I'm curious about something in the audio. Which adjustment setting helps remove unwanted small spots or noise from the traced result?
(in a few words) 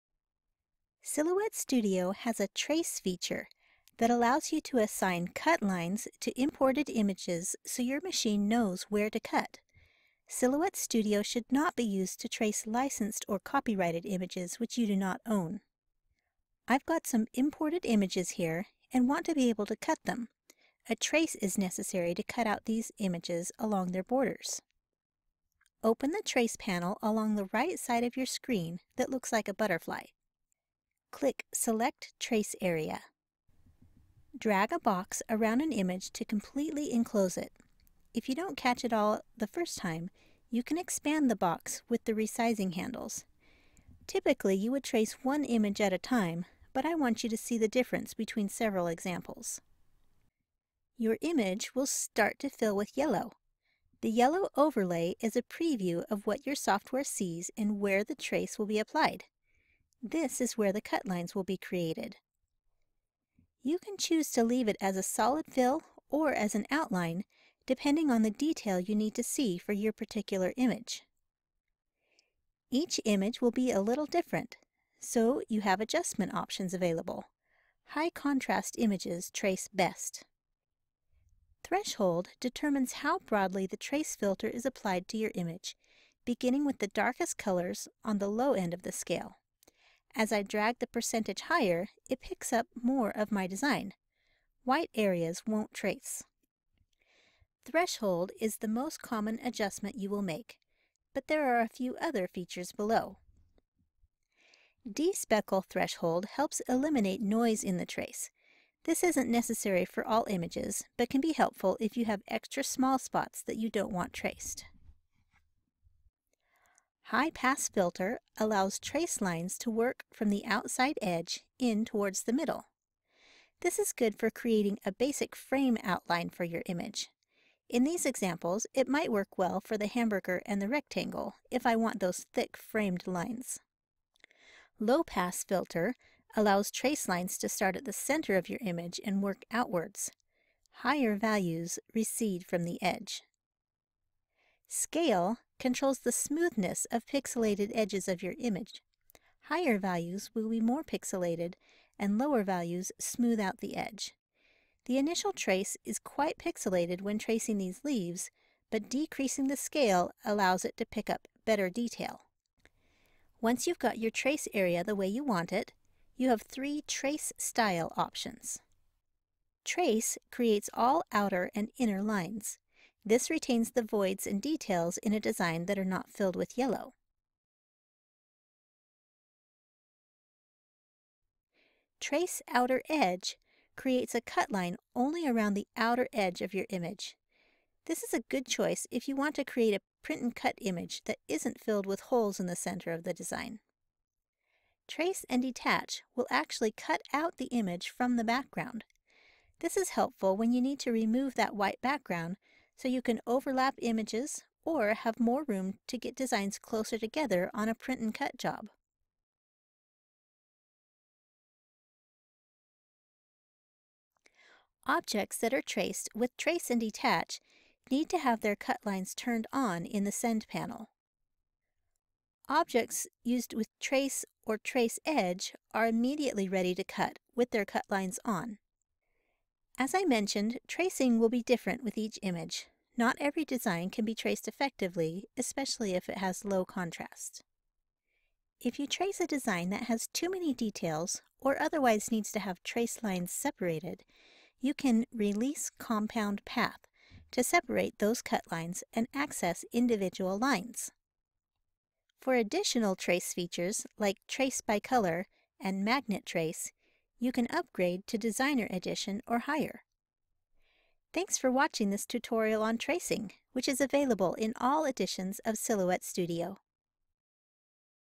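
Despeckle threshold.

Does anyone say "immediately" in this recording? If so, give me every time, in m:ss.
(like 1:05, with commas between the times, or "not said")
3:45.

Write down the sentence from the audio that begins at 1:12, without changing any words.
Each image will be a little different, so you have adjustment options available.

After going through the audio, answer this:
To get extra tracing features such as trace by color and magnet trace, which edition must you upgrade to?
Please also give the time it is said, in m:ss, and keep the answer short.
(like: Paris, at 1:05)
Designer Edition, at 4:18.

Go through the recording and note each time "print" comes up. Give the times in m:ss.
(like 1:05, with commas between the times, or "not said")
3:10, 3:27.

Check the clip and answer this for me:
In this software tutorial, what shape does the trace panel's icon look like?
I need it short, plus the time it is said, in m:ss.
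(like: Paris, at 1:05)
Butterfly, at 0:29.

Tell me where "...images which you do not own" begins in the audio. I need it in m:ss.
0:14.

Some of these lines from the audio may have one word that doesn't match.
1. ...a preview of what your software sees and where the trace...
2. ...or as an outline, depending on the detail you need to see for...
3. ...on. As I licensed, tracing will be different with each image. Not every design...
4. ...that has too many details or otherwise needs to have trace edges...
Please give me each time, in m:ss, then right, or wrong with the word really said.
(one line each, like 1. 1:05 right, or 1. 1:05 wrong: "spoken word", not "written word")
1. 0:55 right
2. 1:06 right
3. 3:48 wrong: "mentioned", not "licensed"
4. 3:59 wrong: "lines", not "edges".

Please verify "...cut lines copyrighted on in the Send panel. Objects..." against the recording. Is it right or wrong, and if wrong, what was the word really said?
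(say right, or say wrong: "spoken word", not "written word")
wrong: "turned", not "copyrighted".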